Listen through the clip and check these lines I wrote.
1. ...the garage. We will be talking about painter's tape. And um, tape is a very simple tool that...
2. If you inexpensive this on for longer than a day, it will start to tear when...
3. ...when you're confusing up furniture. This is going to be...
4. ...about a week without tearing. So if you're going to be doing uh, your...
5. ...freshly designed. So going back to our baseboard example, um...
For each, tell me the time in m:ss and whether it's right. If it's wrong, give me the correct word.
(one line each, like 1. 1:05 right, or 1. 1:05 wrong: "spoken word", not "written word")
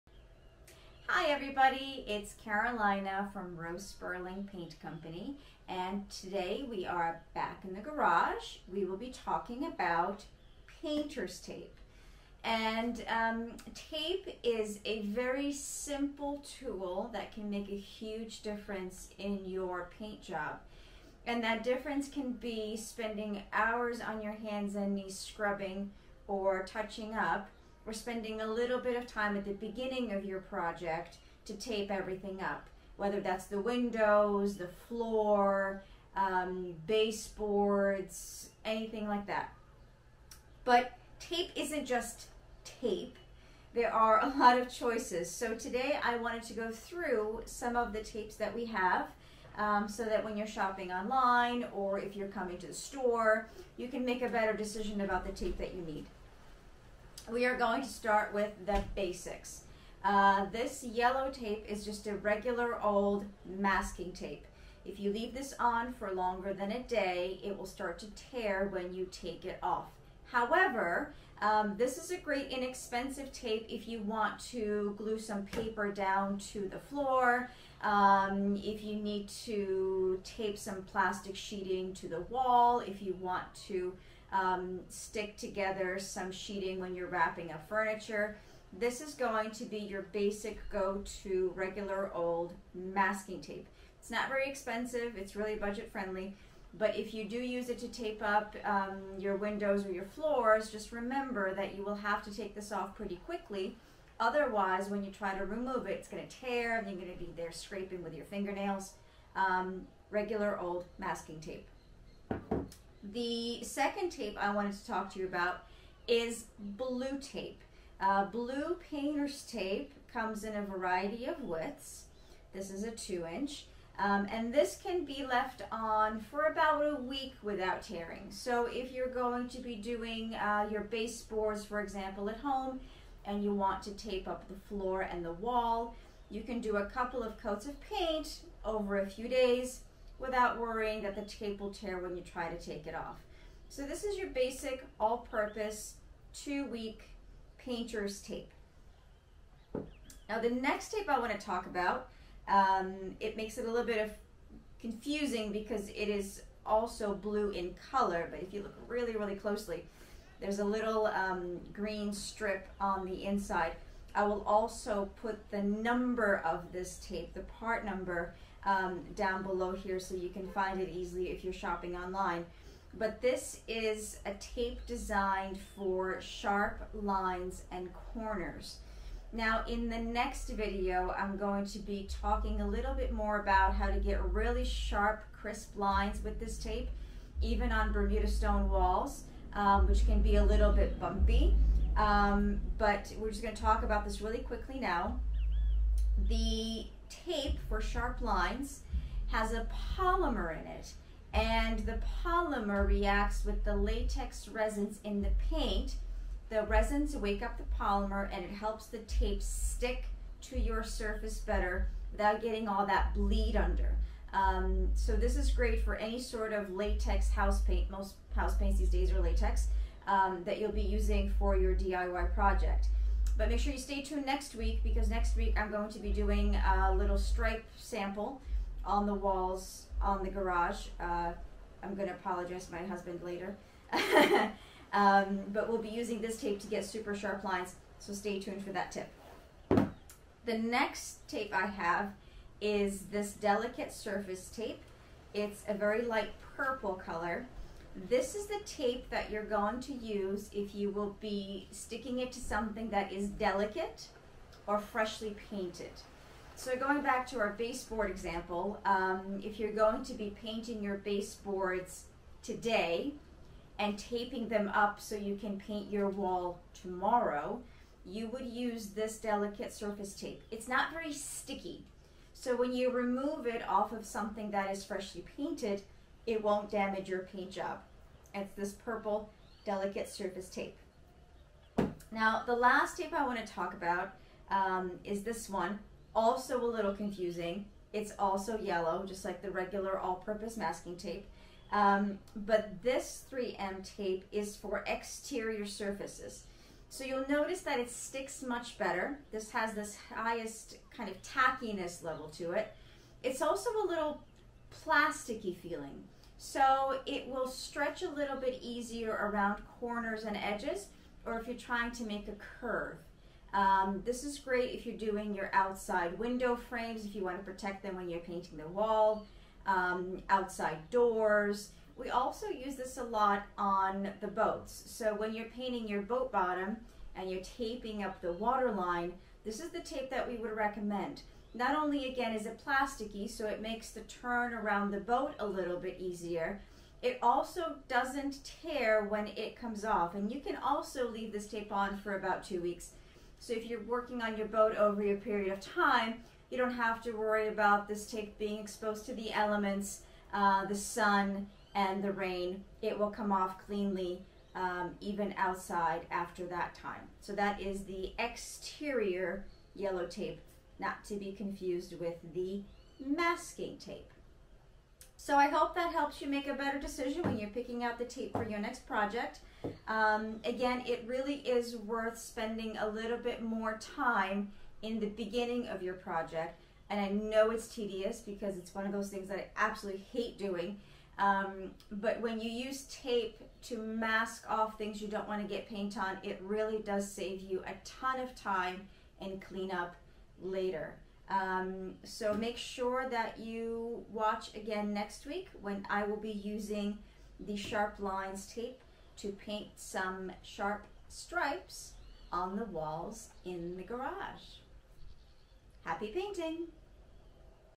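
1. 0:07 right
2. 1:04 wrong: "leave", not "inexpensive"
3. 1:26 wrong: "wrapping", not "confusing"
4. 2:06 right
5. 4:14 wrong: "painted", not "designed".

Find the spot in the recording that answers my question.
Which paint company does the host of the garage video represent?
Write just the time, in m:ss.
0:03.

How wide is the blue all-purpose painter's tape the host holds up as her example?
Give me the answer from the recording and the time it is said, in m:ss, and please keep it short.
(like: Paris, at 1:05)
2 inch, at 2:02.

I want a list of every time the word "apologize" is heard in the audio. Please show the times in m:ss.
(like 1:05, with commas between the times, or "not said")
3:52.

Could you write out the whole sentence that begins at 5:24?
So when you're painting your boat bottom and you're taping up the water line, this is the tape that we would recommend.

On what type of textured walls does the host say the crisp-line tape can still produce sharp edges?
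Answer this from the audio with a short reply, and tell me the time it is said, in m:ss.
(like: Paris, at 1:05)
Bermuda stone walls, at 3:07.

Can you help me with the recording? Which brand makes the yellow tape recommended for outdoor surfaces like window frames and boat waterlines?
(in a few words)
3M.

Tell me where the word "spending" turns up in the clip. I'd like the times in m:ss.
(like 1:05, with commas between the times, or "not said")
0:22, 0:27, 6:12.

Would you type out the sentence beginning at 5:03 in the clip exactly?
It's also a little plasticky feeling.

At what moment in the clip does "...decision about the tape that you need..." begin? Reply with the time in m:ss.
0:54.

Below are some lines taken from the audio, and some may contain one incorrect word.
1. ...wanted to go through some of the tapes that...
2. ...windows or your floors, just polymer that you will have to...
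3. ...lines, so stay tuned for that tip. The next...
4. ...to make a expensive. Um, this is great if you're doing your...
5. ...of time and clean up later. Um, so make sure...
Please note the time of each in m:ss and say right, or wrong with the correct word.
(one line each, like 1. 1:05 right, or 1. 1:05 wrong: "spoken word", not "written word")
1. 0:46 right
2. 1:39 wrong: "remember", not "polymer"
3. 3:57 right
4. 5:11 wrong: "curve", not "expensive"
5. 6:28 right.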